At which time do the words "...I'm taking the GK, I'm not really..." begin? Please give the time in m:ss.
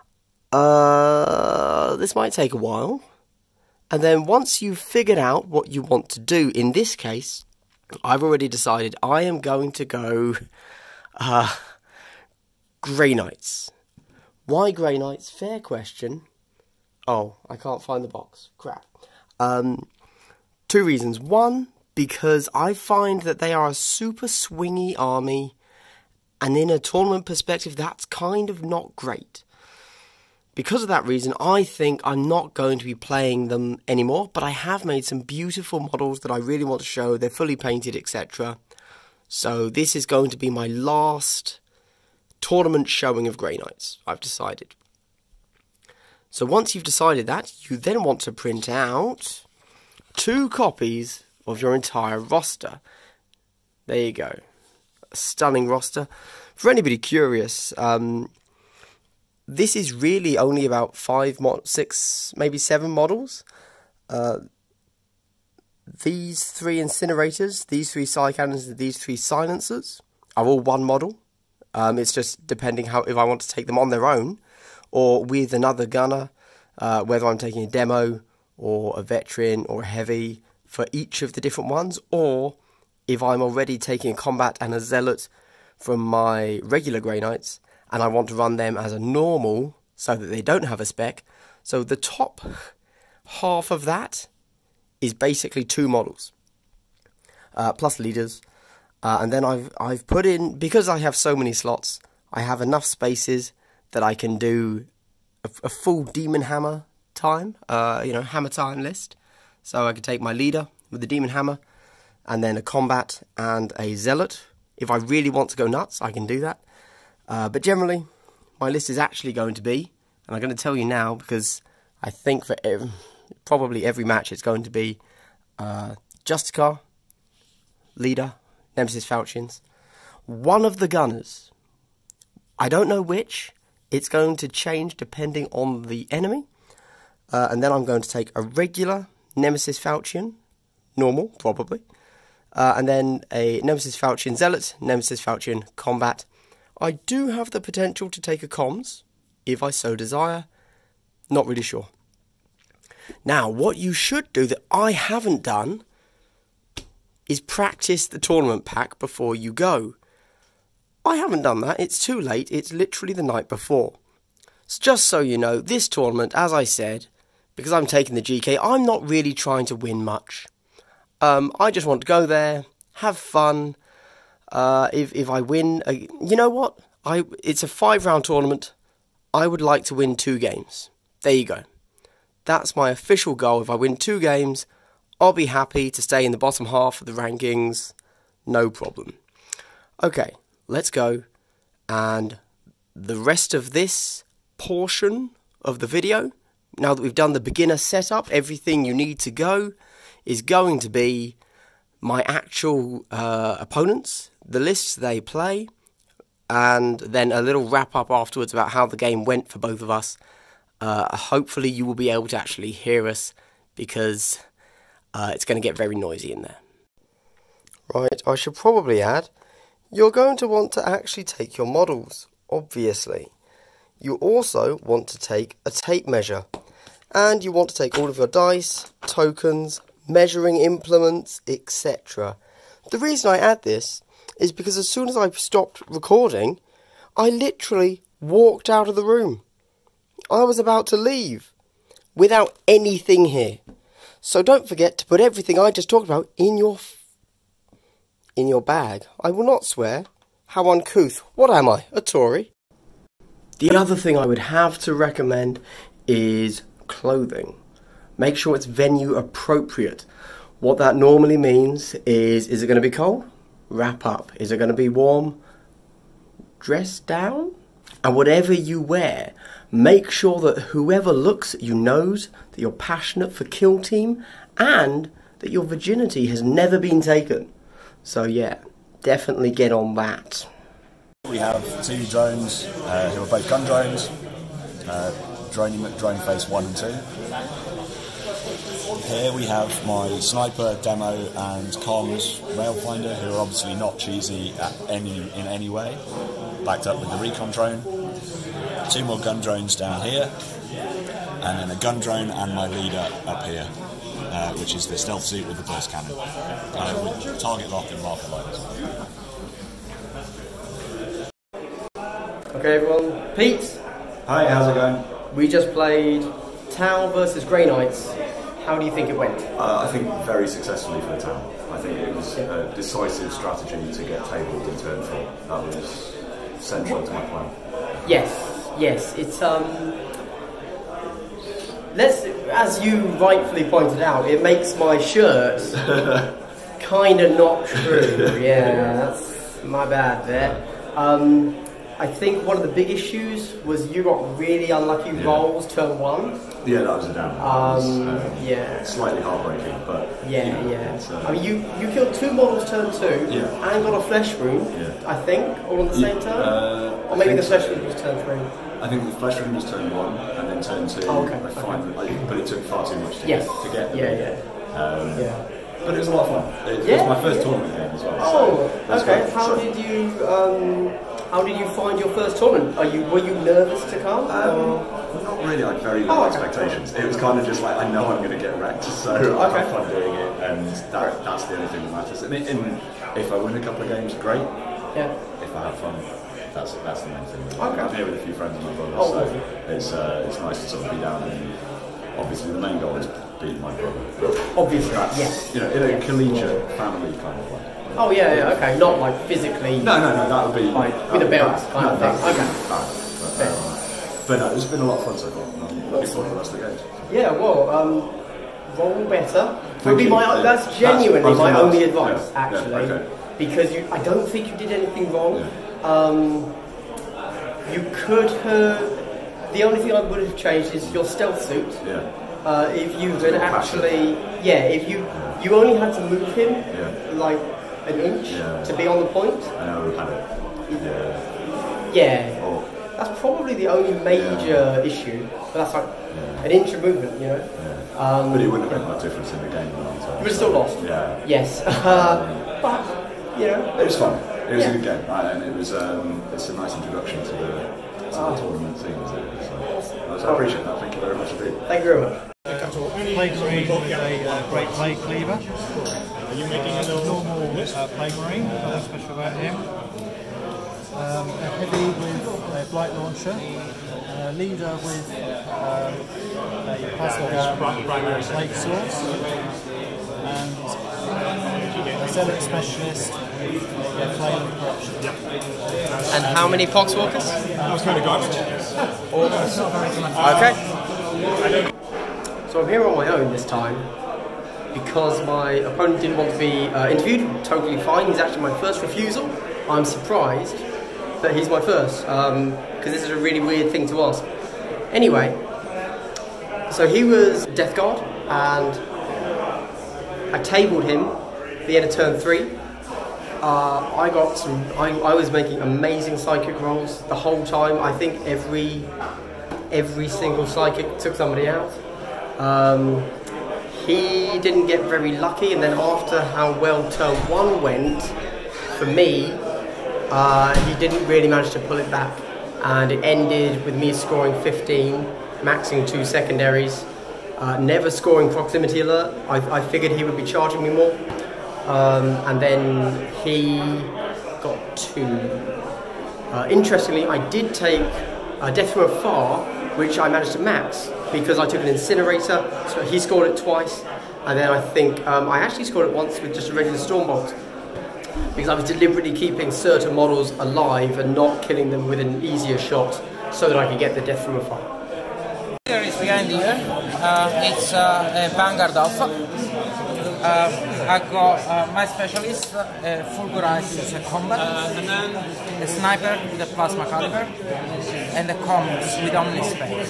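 2:47.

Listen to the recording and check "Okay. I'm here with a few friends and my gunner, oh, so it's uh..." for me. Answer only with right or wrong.
wrong.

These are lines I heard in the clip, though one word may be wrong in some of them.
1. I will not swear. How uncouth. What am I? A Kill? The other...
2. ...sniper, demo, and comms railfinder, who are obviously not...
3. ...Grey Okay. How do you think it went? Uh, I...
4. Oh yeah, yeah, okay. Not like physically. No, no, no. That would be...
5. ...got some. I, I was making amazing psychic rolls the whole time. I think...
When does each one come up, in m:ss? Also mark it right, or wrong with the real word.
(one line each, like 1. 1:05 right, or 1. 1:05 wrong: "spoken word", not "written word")
1. 4:09 wrong: "Tory", not "Kill"
2. 4:50 right
3. 5:17 wrong: "Knights", not "Okay"
4. 6:37 right
5. 8:24 right.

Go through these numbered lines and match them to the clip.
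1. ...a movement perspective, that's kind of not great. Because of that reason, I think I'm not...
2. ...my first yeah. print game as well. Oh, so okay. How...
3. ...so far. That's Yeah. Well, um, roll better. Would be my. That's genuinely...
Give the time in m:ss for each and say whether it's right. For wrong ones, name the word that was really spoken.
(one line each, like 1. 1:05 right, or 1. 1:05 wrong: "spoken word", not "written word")
1. 0:26 wrong: "tournament", not "movement"
2. 6:07 wrong: "tournament", not "print"
3. 6:45 right.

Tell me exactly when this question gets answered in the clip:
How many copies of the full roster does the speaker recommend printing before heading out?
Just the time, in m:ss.
0:50.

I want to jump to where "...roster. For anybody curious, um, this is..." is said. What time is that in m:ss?
0:55.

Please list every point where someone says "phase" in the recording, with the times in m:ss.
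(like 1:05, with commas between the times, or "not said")
4:46.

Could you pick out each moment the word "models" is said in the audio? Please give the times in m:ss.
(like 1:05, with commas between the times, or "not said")
0:35, 1:02, 1:10, 1:35, 3:41, 5:52, 9:09.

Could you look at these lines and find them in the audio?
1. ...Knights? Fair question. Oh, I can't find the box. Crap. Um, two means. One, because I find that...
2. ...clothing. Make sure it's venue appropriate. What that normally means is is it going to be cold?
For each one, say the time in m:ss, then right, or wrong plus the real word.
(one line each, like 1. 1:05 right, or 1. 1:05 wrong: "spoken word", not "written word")
1. 0:14 wrong: "reasons", not "means"
2. 4:16 right.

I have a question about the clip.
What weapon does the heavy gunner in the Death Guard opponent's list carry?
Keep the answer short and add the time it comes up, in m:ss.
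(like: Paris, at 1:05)
blight launcher, at 7:42.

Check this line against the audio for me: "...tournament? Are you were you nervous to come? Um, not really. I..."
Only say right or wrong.
right.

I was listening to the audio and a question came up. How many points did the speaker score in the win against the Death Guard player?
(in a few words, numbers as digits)
15.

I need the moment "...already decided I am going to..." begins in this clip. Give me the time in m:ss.
0:08.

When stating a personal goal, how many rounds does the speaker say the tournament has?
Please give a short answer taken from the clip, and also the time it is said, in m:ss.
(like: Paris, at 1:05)
5, at 2:57.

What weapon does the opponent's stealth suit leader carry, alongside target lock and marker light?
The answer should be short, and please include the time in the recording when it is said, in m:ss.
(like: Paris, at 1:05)
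burst cannon, at 5:05.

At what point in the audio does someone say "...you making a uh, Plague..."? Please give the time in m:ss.
7:36.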